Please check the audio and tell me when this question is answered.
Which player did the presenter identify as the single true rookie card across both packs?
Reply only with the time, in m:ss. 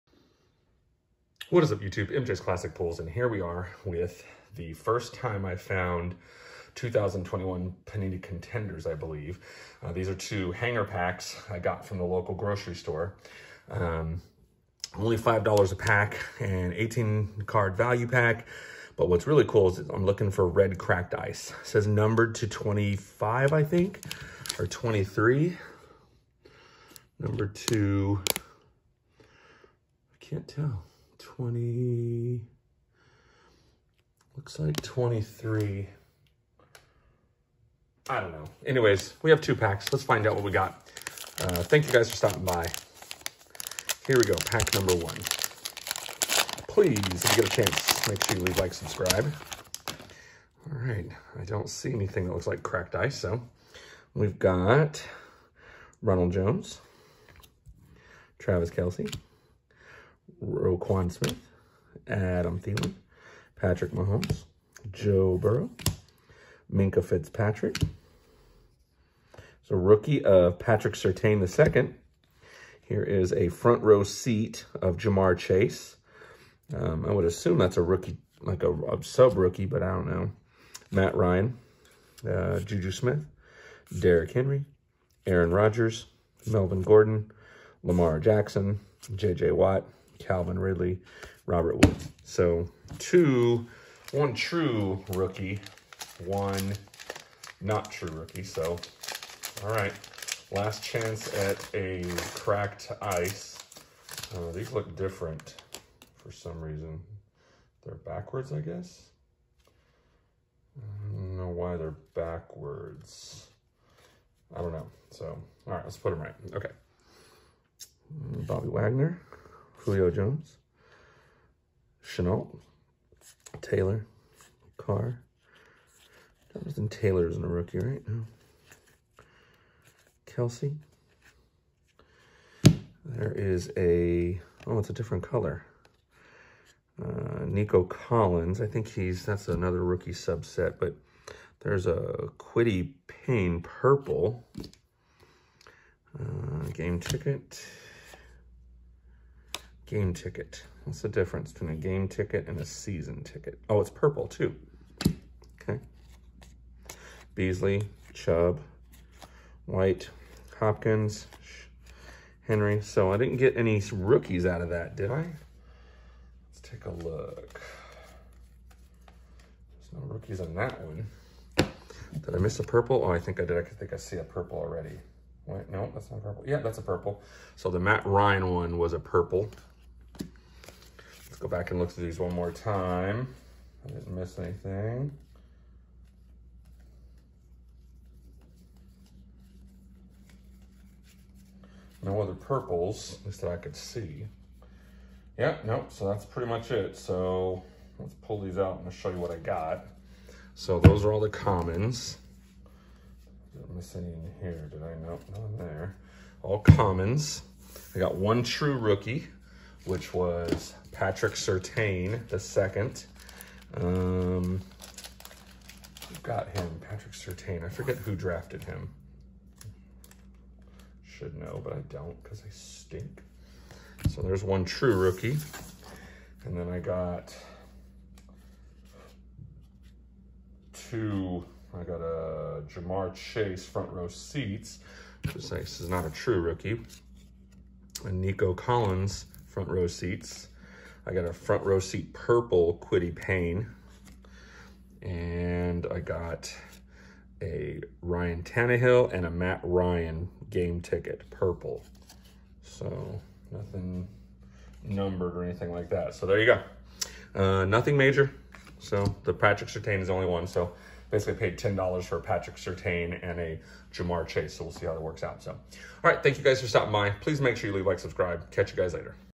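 1:10.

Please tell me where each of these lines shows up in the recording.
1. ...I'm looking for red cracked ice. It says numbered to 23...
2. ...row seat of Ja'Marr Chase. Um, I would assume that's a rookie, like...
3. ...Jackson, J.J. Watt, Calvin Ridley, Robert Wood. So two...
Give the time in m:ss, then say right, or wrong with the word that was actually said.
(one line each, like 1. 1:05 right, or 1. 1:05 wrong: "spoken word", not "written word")
1. 0:19 wrong: "25", not "23"
2. 1:13 right
3. 1:28 right.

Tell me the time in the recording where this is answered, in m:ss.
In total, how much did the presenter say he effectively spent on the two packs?
4:21.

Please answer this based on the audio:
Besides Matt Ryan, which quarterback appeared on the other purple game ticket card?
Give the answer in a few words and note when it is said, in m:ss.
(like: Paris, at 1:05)
Ryan Tannehill, at 4:08.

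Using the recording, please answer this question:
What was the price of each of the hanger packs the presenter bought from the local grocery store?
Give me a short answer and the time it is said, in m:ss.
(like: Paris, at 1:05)
$5, at 0:15.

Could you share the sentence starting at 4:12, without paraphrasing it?
So nothing numbered or anything like that.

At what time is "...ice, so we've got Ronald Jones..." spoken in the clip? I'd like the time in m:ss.
0:52.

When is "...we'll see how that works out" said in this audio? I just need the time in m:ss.
4:24.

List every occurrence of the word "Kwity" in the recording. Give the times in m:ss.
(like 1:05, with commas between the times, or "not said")
2:22, 4:02.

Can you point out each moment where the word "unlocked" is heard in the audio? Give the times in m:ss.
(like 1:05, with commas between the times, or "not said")
not said.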